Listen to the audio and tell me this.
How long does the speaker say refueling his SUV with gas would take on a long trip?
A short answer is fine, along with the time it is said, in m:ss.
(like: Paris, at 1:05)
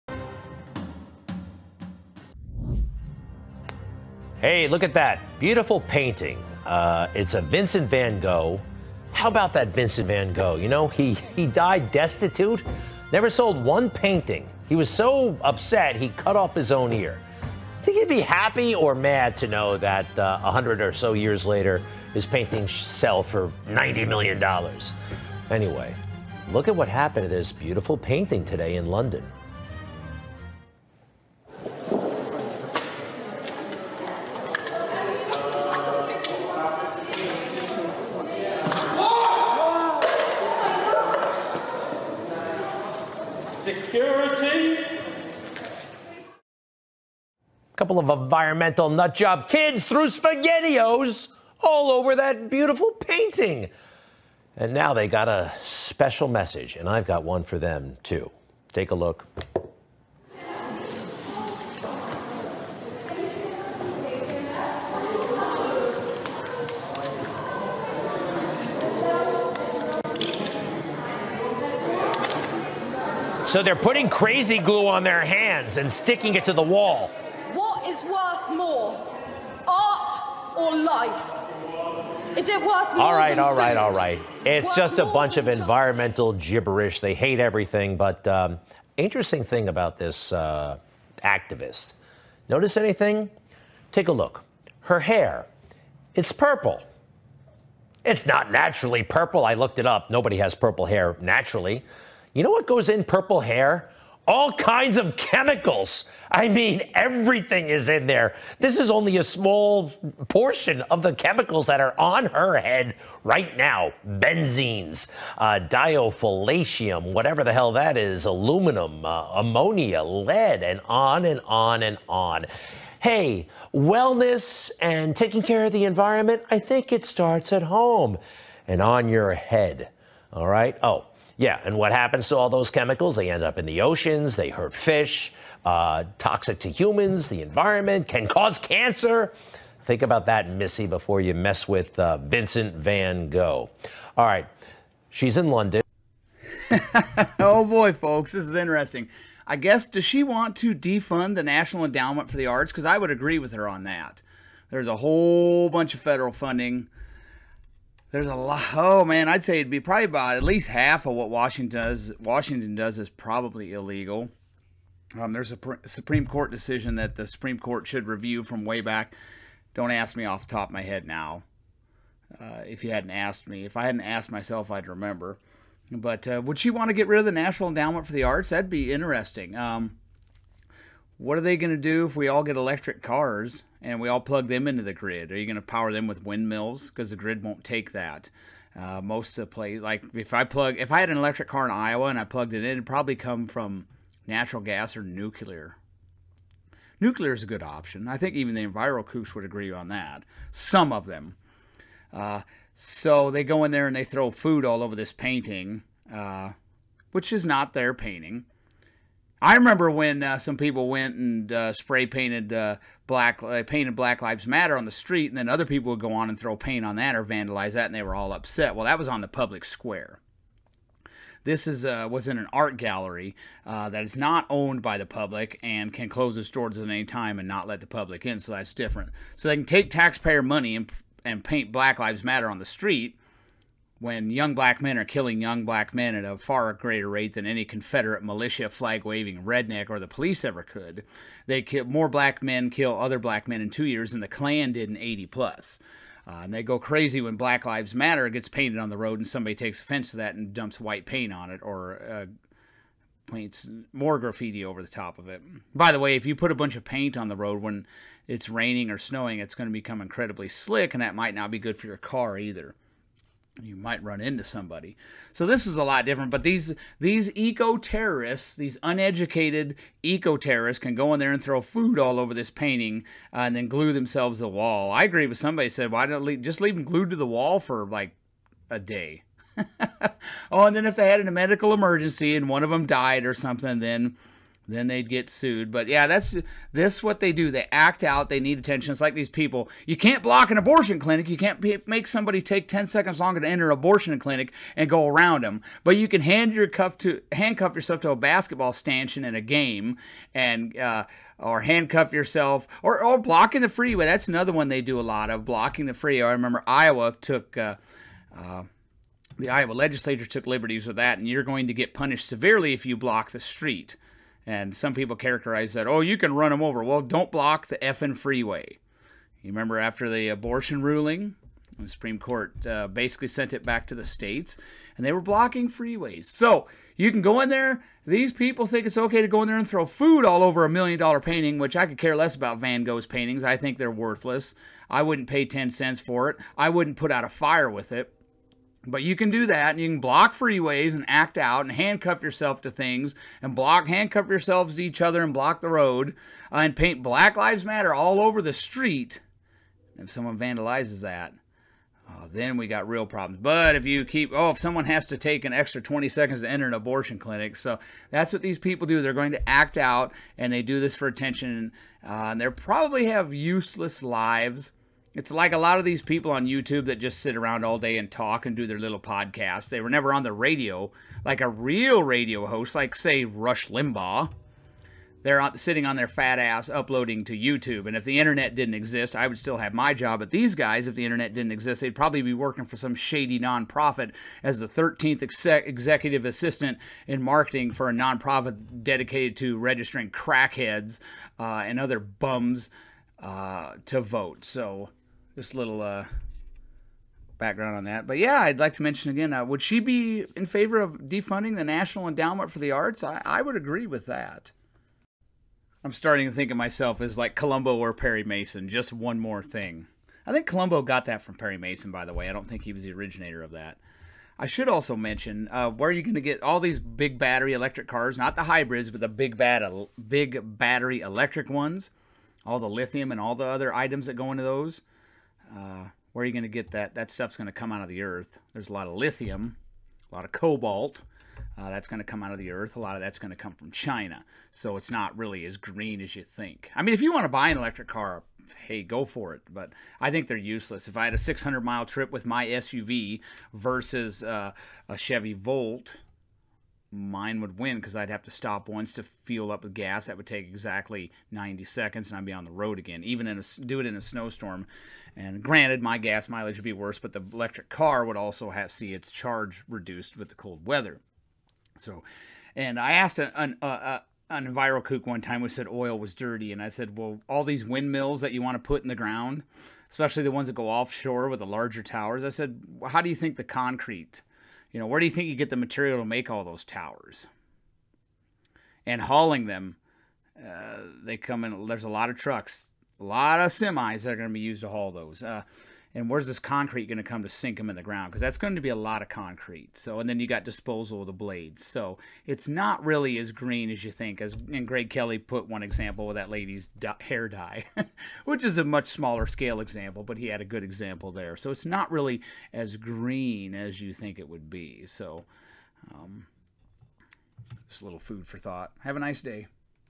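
90 seconds, at 7:31.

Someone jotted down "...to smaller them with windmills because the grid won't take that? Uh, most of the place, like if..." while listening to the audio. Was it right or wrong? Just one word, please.
wrong.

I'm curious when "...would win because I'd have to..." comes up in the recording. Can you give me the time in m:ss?
7:27.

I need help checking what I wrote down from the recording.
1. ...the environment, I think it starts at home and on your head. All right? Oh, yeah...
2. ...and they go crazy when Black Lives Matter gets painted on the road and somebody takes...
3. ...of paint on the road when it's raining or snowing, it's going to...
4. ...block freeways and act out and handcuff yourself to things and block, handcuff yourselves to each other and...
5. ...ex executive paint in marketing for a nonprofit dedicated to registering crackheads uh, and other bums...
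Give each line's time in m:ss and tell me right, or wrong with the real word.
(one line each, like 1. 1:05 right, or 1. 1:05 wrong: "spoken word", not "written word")
1. 2:05 right
2. 4:06 right
3. 4:16 right
4. 5:39 right
5. 6:25 wrong: "assistant", not "paint".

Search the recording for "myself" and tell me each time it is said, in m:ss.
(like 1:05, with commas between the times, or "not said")
2:54, 6:46.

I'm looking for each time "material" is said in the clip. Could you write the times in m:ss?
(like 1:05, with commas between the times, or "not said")
7:55.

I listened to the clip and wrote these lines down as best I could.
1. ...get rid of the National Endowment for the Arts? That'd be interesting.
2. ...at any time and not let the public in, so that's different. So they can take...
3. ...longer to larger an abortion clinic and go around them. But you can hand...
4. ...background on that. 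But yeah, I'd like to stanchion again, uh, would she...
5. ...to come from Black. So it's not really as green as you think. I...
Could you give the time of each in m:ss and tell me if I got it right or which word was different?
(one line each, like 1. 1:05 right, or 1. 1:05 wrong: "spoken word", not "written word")
1. 2:56 right
2. 3:46 right
3. 4:53 wrong: "enter", not "larger"
4. 6:37 wrong: "mention", not "stanchion"
5. 7:13 wrong: "China", not "Black".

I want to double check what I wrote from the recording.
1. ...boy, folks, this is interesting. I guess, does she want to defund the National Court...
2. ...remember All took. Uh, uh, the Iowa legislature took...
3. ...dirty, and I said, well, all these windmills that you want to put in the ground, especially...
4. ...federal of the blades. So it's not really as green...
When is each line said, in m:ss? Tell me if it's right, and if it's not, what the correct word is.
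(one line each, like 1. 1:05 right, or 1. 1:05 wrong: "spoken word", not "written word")
1. 2:27 wrong: "Endowment", not "Court"
2. 5:06 wrong: "Iowa", not "All"
3. 7:46 right
4. 8:10 wrong: "disposal", not "federal".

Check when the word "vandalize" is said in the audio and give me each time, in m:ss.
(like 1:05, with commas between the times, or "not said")
3:37, 5:50.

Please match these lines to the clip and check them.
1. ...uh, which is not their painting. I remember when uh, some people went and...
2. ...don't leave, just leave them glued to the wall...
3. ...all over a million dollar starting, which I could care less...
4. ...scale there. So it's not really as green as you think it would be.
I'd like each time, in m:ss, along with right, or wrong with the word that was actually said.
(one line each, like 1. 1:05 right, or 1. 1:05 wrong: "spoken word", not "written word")
1. 3:26 right
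2. 4:36 right
3. 5:30 wrong: "painting", not "starting"
4. 8:20 wrong: "example", not "scale".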